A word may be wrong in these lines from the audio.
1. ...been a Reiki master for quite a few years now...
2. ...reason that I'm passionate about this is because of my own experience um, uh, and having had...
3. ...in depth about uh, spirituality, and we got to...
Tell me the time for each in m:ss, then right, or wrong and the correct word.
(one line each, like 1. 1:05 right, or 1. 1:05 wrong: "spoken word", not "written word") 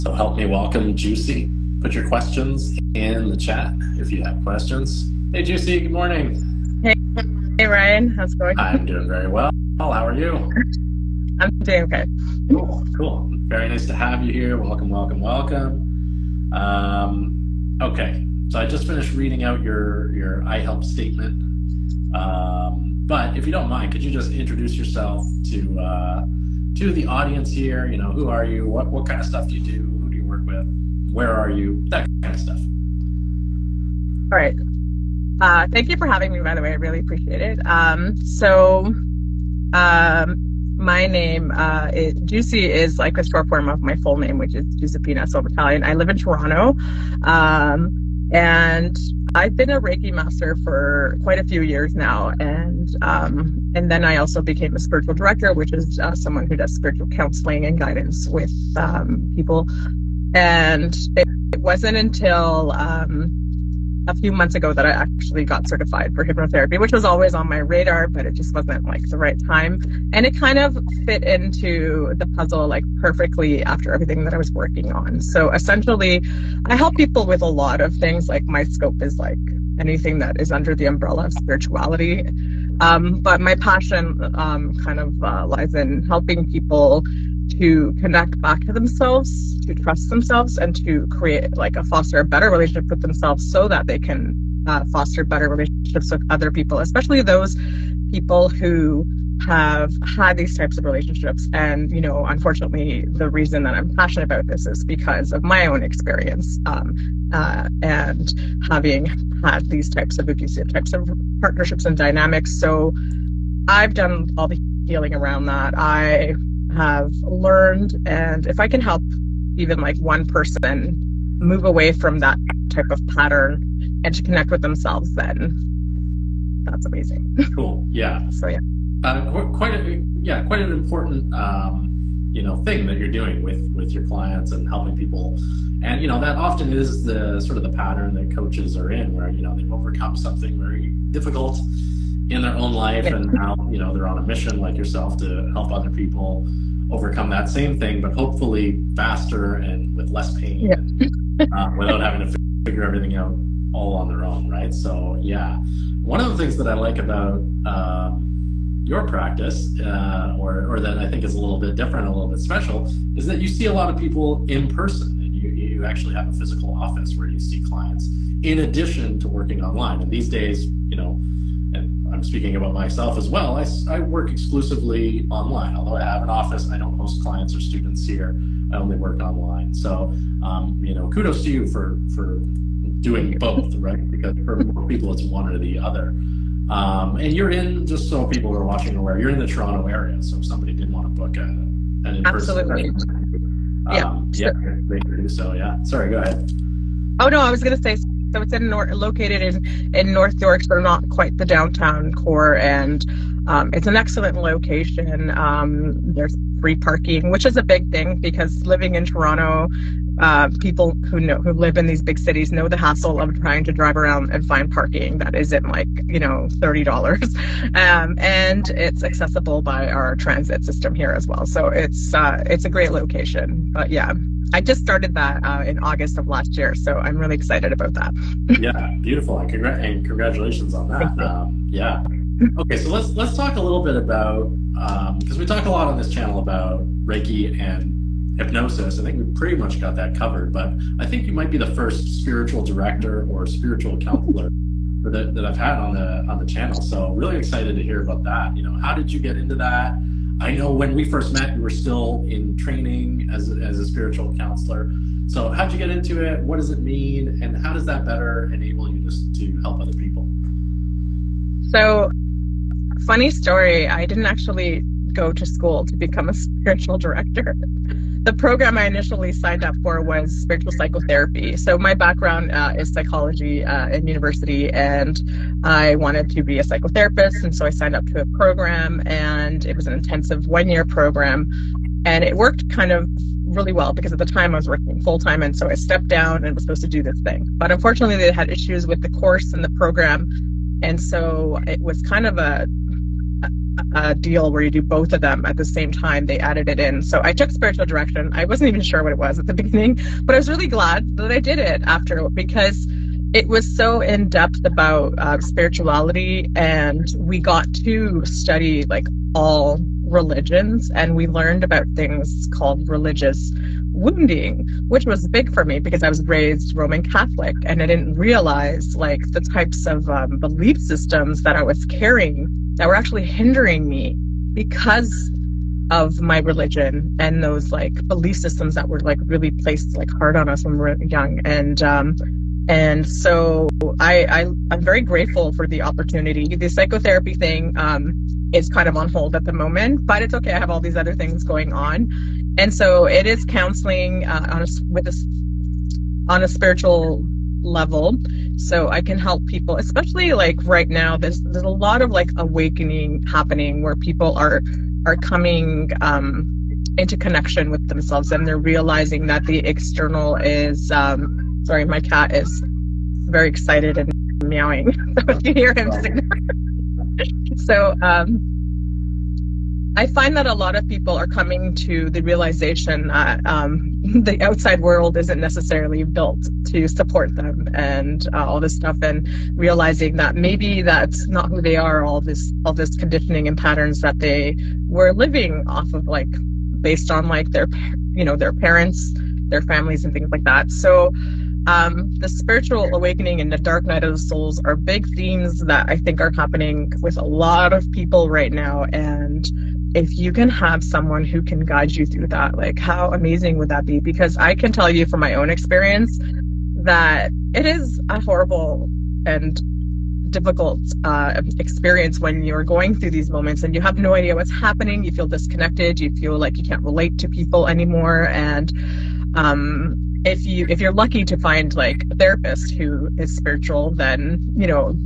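1. 0:49 right
2. 1:43 right
3. 5:04 right.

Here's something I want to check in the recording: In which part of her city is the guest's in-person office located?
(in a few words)
North York.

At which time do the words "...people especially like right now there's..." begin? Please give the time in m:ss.
5:49.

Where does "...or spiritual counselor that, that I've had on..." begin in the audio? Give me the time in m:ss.
4:03.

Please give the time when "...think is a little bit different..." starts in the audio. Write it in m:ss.
2:41.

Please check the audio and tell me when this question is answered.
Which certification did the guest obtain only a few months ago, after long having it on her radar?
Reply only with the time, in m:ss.
1:06.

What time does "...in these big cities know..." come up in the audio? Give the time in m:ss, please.
3:31.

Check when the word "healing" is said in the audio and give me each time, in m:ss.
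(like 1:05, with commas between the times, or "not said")
1:54.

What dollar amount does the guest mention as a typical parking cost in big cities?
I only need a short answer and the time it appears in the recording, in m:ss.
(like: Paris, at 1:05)
30 dollars, at 3:36.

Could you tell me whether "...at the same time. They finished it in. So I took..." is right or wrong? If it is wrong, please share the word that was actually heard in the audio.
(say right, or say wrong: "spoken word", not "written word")
wrong: "added", not "finished".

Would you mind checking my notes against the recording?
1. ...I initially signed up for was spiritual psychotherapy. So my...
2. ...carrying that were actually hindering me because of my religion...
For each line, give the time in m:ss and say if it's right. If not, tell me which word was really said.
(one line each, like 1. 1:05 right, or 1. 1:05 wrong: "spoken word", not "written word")
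1. 4:28 right
2. 5:21 right.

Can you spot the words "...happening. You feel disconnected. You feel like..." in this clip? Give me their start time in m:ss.
6:54.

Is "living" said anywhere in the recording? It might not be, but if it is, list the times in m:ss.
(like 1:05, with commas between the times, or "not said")
3:28, 6:25.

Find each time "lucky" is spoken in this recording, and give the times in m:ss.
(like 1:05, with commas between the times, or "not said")
7:00.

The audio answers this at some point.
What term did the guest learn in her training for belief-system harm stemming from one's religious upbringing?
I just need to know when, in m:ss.
5:12.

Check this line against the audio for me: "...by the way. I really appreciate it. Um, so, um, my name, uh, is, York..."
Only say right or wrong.
wrong.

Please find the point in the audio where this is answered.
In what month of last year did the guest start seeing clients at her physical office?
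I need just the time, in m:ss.
3:45.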